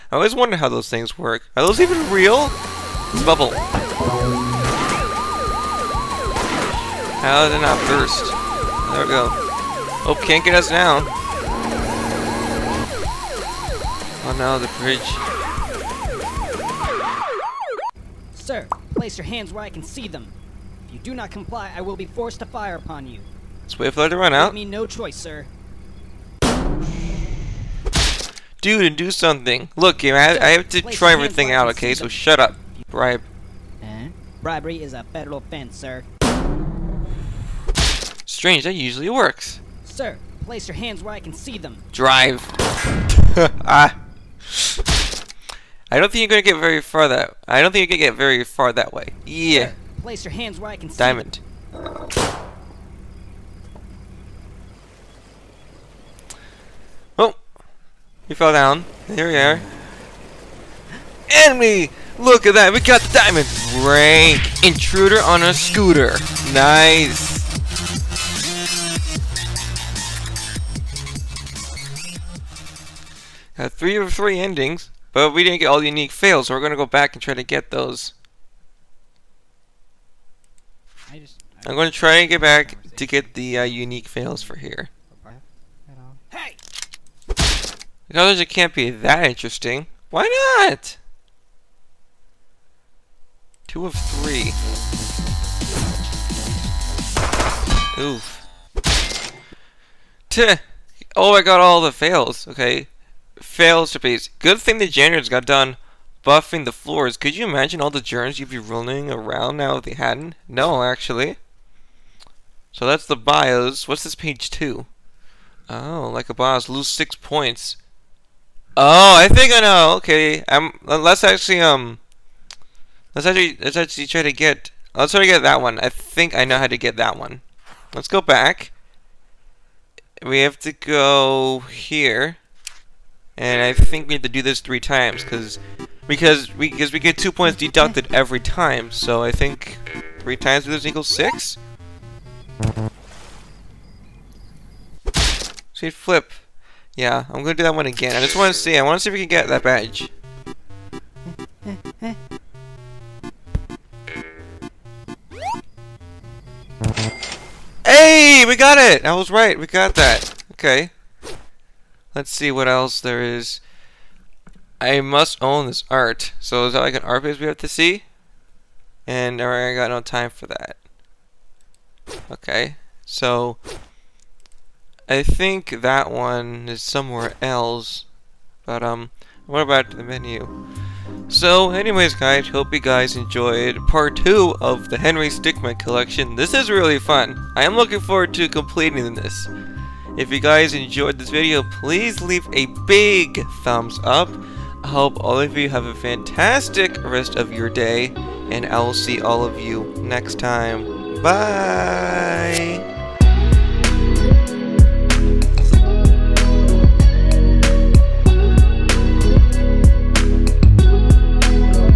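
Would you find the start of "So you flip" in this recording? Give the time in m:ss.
2:25.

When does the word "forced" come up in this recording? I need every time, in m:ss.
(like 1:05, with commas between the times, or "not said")
0:22.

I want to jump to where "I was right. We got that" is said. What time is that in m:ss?
2:39.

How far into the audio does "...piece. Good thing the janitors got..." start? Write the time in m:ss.
1:43.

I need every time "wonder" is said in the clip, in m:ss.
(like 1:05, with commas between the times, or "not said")
0:00.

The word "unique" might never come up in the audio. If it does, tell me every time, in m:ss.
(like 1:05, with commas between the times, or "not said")
1:15, 1:23.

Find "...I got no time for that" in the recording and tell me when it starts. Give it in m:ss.
2:49.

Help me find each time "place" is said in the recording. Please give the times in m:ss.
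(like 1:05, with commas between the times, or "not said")
0:18, 0:40, 0:50.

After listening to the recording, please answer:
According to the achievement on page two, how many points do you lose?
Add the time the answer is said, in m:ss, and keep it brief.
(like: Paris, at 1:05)
6, at 1:56.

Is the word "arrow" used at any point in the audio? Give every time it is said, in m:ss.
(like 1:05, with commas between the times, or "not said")
not said.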